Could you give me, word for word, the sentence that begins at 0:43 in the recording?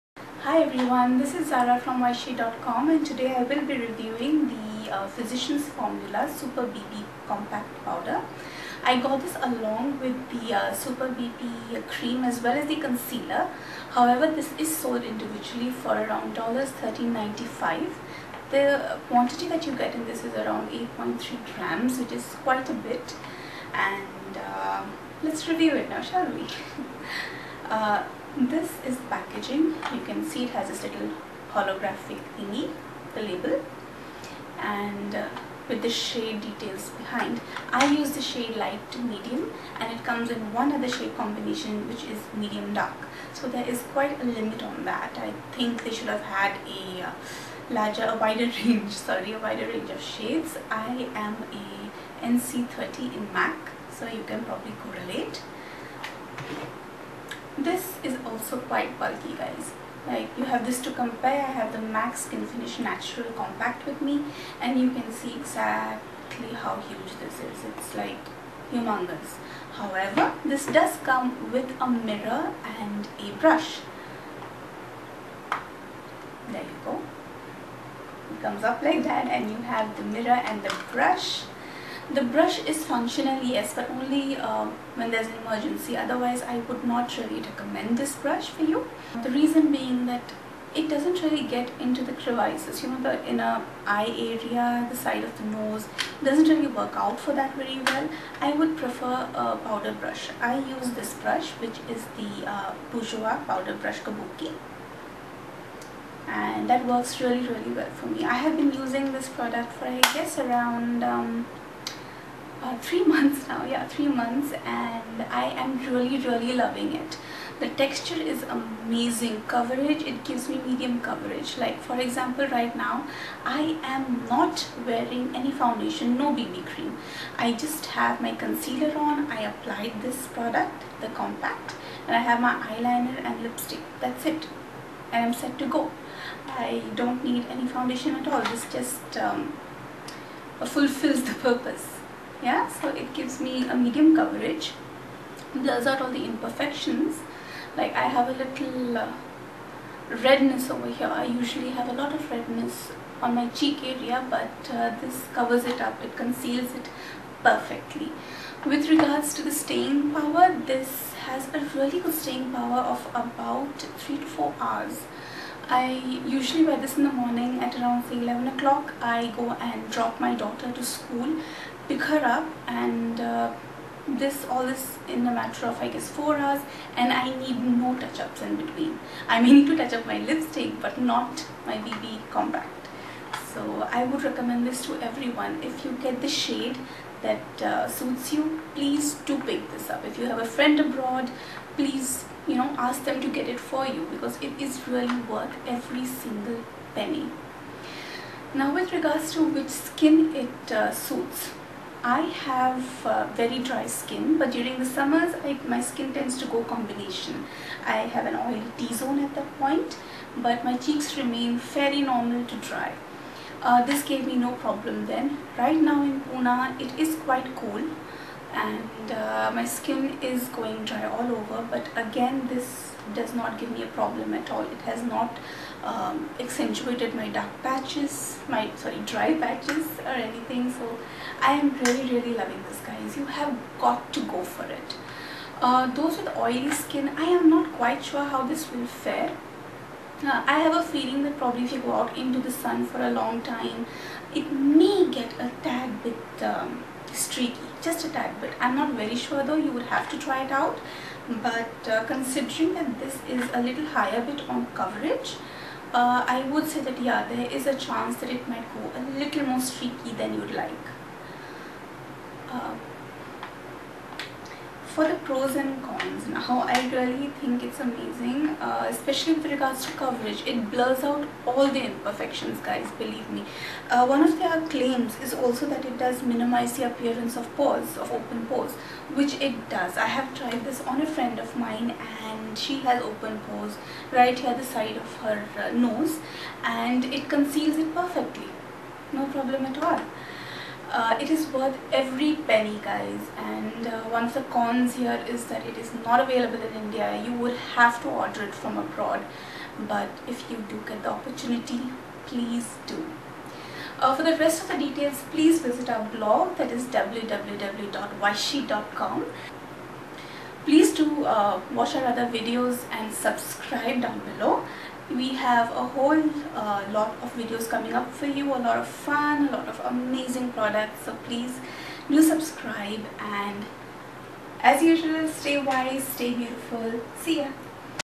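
So there is quite a limit on that.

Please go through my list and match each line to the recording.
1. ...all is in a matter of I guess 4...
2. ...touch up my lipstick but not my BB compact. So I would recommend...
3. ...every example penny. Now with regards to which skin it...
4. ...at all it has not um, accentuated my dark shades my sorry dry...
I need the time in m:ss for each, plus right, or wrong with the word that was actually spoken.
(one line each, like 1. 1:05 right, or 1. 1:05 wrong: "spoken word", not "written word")
1. 2:54 right
2. 2:59 right
3. 3:15 wrong: "single", not "example"
4. 3:44 wrong: "patches", not "shades".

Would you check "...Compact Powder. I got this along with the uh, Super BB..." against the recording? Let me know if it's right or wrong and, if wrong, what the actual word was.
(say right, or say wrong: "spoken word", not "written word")
right.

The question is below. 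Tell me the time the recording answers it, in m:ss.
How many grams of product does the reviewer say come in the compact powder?
0:20.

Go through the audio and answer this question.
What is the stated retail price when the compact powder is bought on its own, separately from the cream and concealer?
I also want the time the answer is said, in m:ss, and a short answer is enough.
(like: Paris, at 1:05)
$13.95, at 0:16.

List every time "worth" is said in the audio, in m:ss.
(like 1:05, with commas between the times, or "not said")
3:15, 4:51.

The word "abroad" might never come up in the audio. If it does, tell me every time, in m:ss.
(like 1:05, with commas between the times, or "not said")
3:10, 4:58.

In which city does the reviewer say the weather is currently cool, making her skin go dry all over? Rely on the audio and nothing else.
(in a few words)
Pune.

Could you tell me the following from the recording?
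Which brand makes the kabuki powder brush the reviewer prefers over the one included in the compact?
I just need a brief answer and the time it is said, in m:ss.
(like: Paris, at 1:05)
Bourjois, at 1:42.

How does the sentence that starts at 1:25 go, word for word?
Otherwise, I would not really recommend this brush for you.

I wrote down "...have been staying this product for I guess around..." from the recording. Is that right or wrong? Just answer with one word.
wrong.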